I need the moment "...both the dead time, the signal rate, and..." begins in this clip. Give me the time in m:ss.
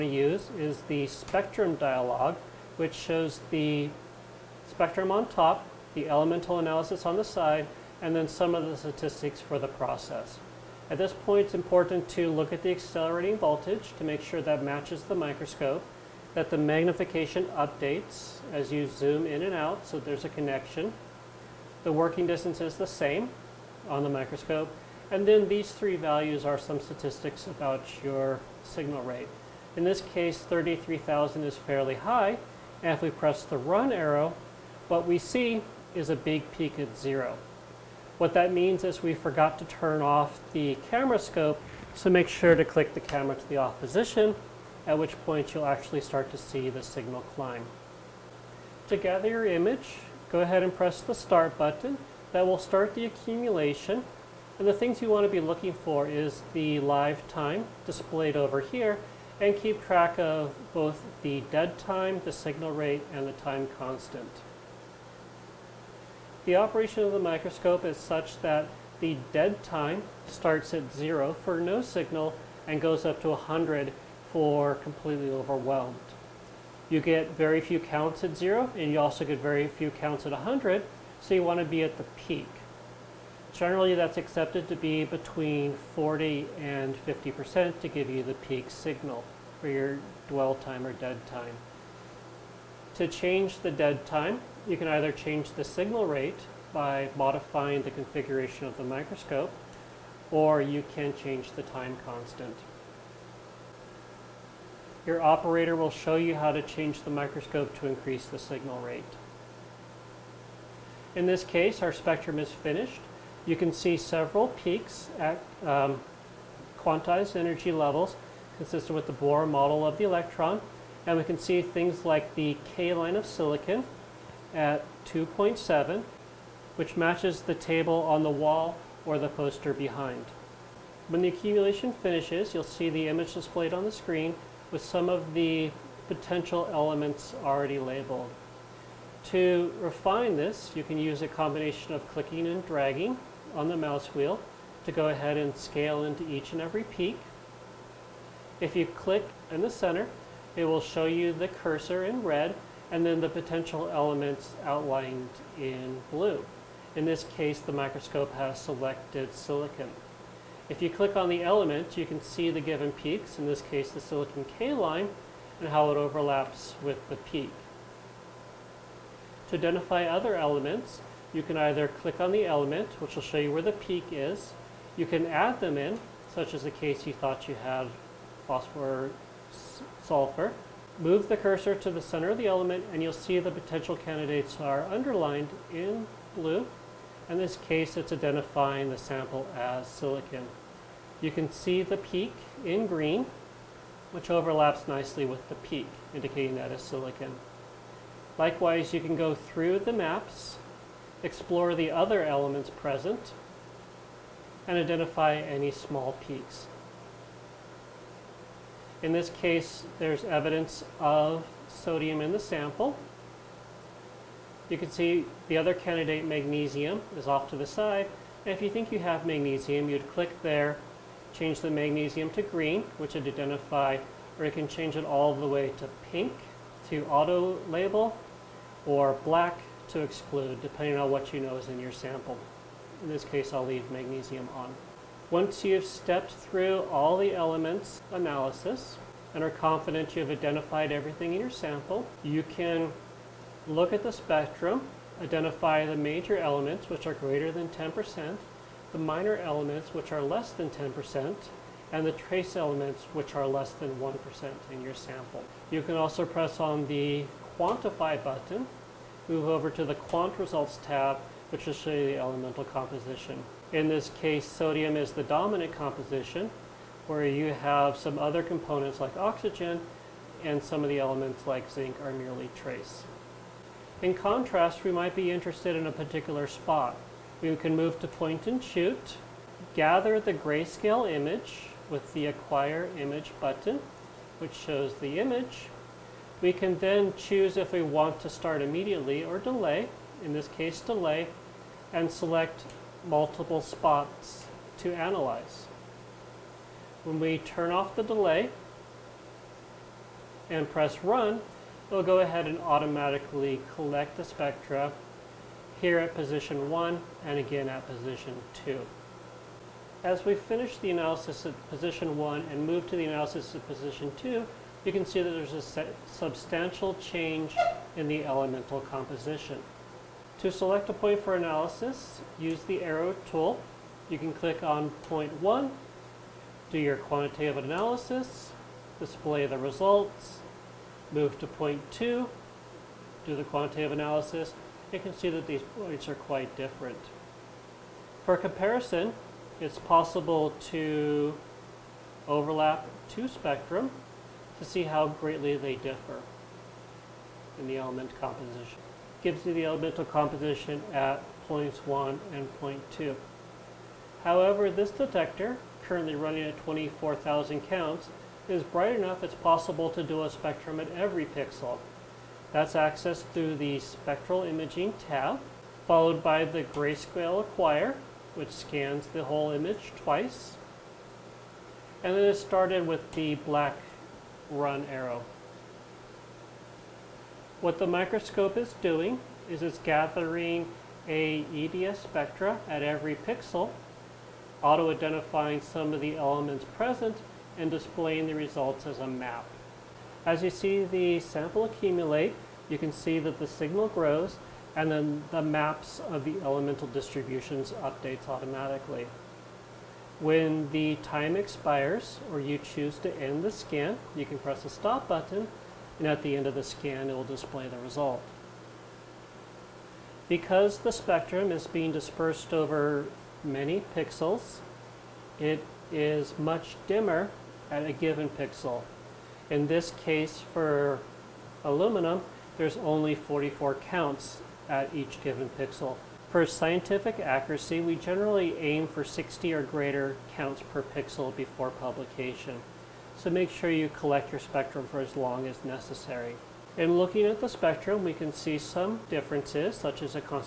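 1:00.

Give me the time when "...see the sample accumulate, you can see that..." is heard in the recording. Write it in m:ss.
6:30.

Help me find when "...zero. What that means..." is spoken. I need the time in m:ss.
0:36.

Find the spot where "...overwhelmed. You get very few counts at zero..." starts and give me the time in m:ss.
1:15.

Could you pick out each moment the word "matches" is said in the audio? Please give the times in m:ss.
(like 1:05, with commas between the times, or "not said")
0:14, 2:06.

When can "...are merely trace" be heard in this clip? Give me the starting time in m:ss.
4:32.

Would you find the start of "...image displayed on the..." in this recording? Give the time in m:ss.
2:13.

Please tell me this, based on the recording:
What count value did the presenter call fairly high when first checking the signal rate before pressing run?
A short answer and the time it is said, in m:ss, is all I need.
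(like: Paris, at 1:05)
33,000, at 0:30.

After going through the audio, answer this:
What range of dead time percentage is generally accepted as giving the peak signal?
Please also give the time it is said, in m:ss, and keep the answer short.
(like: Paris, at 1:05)
40 and 50%, at 1:25.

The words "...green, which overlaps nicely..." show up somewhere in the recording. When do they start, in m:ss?
3:12.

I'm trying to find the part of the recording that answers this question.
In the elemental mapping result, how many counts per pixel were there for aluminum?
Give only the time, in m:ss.
7:03.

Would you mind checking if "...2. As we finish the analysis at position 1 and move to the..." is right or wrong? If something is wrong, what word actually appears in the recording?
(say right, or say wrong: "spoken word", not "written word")
right.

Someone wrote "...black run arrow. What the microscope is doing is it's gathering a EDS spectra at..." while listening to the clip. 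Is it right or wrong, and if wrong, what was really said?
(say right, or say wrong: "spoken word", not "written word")
right.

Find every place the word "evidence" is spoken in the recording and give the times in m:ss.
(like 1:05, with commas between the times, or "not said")
3:30.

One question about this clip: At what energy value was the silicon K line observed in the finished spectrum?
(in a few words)
2.7.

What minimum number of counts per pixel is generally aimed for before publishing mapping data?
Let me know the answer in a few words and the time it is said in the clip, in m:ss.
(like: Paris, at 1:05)
60, at 7:09.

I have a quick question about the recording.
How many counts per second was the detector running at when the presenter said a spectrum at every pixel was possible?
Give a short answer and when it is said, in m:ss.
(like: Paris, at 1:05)
24,000, at 5:56.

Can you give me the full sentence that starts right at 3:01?
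Move the cursor to the center of the element and you'll see the potential candidates are underlined in blue.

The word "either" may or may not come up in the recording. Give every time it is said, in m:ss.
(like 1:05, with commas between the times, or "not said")
1:34, 2:51.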